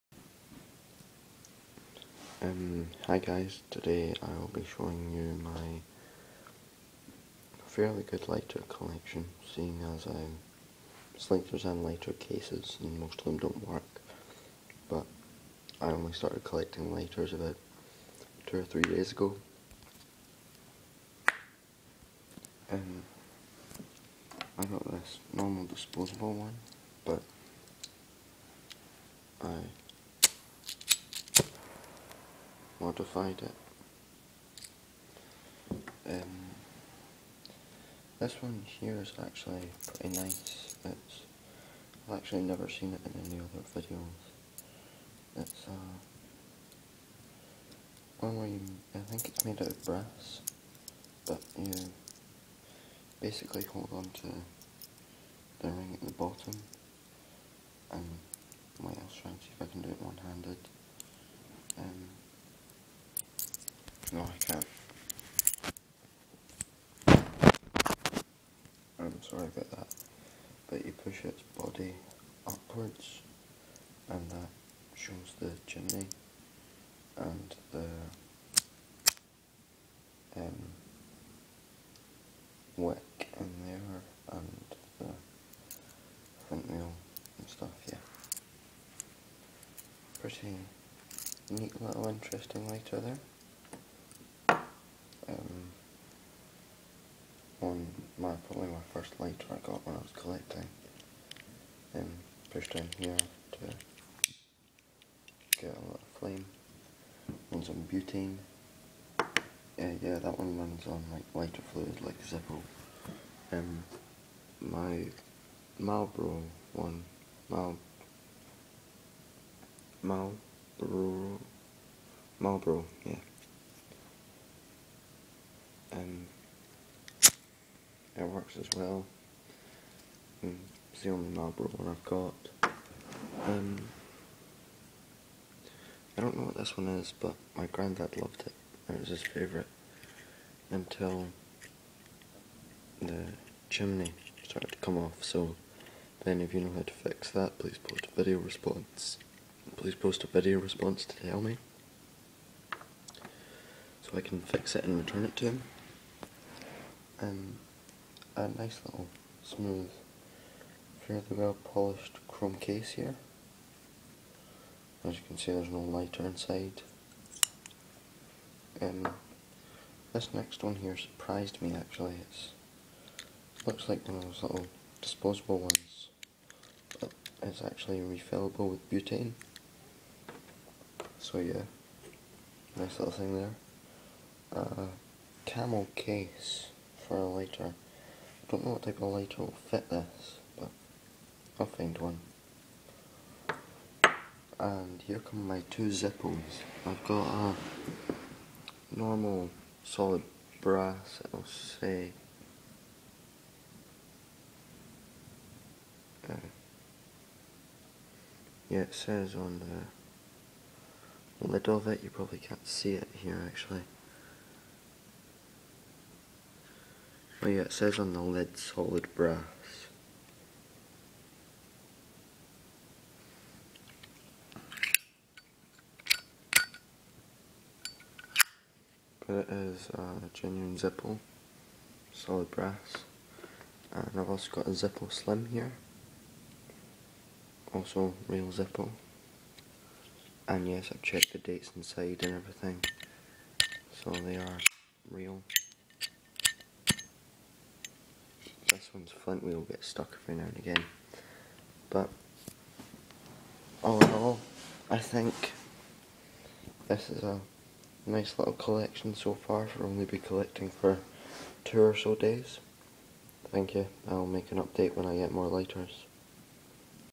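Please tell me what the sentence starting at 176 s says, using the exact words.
But it's actually refillable with butane.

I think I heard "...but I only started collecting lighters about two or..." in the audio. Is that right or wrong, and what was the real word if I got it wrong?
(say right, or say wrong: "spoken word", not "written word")
right.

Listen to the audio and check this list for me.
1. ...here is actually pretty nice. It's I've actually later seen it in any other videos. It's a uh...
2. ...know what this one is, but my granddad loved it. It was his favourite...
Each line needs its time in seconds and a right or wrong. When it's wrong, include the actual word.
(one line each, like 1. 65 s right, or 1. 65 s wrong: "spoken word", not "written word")
1. 38 s wrong: "never", not "later"
2. 136 s right.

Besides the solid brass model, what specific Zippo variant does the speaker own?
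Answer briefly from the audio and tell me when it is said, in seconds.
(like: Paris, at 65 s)
Zippo Slim, at 234 s.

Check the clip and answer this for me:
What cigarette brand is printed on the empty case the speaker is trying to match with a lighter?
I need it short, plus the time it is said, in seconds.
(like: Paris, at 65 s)
Camel, at 185 s.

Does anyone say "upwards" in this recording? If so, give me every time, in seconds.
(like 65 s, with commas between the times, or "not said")
72 s.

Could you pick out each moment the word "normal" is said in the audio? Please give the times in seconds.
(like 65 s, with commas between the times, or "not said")
25 s, 198 s.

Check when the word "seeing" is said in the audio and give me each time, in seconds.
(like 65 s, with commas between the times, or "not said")
9 s.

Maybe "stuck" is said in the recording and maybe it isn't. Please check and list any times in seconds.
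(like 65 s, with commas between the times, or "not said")
249 s.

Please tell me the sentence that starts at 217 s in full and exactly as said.
Oh yeah, it says on the lid solid brass.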